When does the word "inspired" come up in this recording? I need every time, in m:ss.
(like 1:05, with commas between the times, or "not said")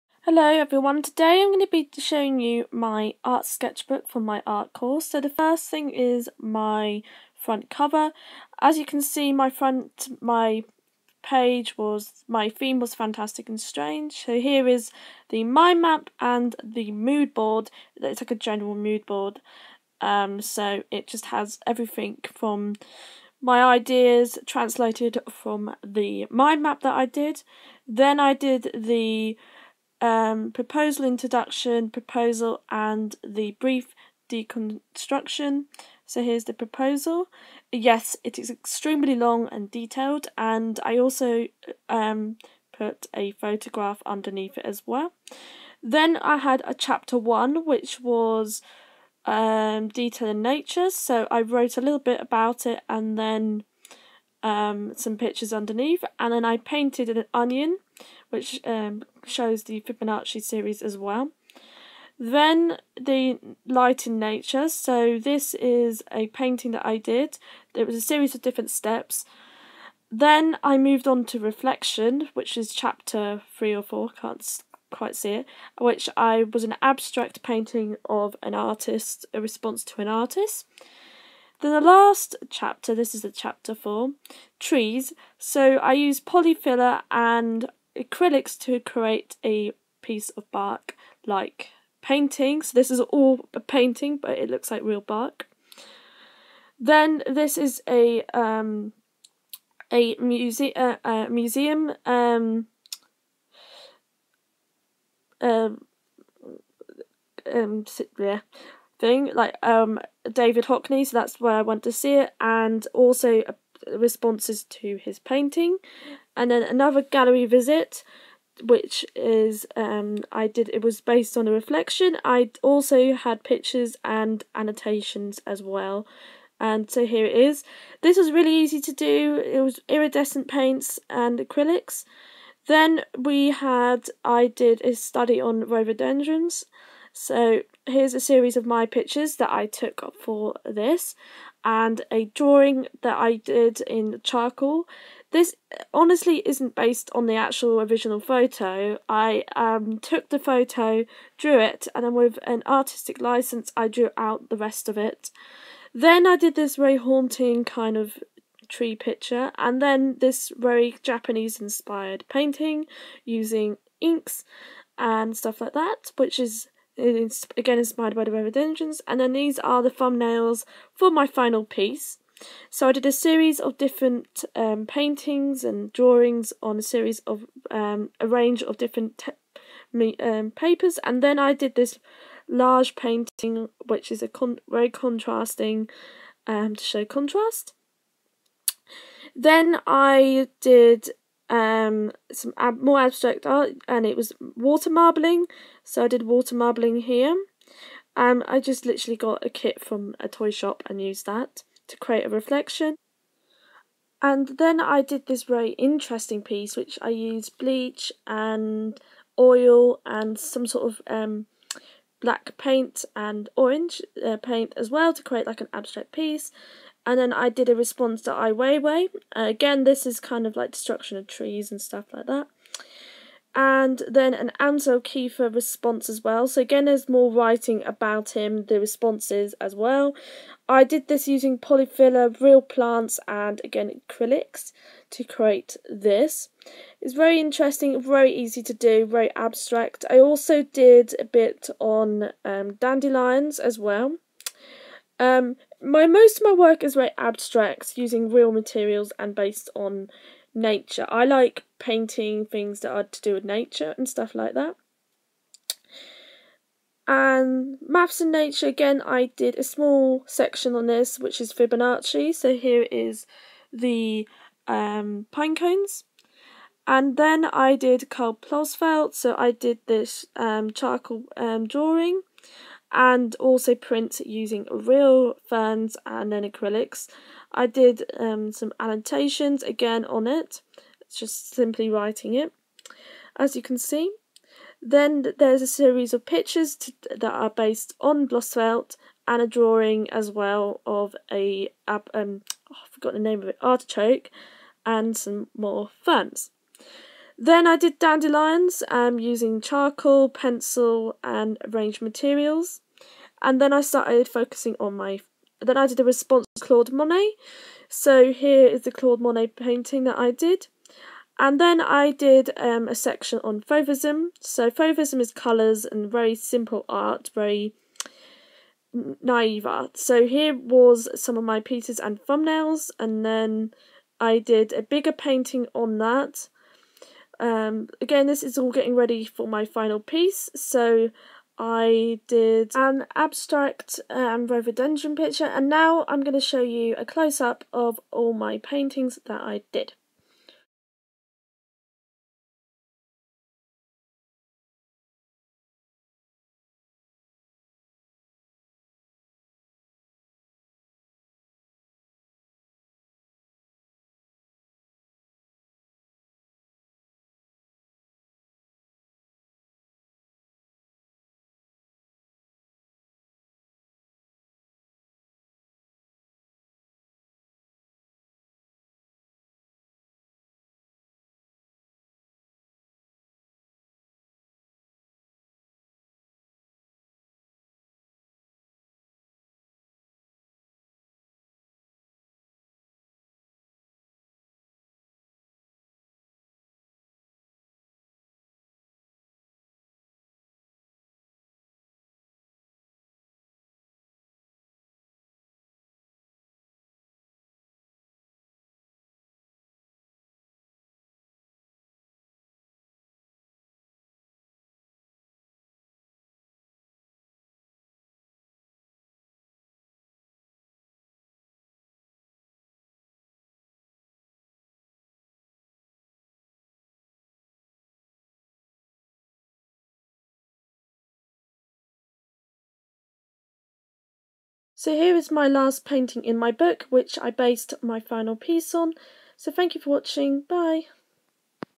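2:41, 2:47.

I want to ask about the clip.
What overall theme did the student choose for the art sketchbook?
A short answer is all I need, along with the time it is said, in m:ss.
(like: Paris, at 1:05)
Fantastic and strange, at 0:12.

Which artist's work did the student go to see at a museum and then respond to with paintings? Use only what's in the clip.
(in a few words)
David Hockney.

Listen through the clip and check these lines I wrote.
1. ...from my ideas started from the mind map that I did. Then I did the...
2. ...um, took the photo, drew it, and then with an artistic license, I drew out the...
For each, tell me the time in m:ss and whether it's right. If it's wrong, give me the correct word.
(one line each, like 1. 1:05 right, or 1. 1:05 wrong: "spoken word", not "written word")
1. 0:22 wrong: "translated", not "started"
2. 2:29 right.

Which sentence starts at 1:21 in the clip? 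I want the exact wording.
Then the last chapter, this is the chapter four, trees.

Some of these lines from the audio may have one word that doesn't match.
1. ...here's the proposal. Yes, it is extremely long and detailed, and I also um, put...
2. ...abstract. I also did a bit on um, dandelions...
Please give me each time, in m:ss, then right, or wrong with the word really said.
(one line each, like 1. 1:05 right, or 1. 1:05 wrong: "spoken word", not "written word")
1. 0:36 right
2. 3:59 right.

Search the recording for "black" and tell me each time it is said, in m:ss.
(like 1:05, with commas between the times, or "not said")
3:32.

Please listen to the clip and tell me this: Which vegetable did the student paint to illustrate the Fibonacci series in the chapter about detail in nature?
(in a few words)
Onion.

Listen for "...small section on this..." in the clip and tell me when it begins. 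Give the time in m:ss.
4:19.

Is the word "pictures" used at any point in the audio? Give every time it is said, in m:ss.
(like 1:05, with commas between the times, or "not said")
0:55, 2:03, 2:18, 2:38, 4:46, 5:35.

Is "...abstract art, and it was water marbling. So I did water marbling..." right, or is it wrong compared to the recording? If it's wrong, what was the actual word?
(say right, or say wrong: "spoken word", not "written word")
right.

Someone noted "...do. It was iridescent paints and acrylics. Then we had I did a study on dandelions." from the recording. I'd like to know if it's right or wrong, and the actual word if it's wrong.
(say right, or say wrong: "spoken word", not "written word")
wrong: "rhododendrons", not "dandelions".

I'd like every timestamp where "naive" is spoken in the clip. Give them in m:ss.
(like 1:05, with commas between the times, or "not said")
5:18.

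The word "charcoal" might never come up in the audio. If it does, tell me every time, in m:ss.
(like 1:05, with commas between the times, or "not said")
2:24, 4:30, 4:59.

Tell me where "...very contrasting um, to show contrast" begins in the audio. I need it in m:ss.
3:04.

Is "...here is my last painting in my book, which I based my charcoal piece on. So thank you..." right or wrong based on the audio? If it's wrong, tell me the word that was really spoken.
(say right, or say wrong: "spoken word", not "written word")
wrong: "final", not "charcoal".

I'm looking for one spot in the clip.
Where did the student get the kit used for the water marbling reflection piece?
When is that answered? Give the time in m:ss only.
3:20.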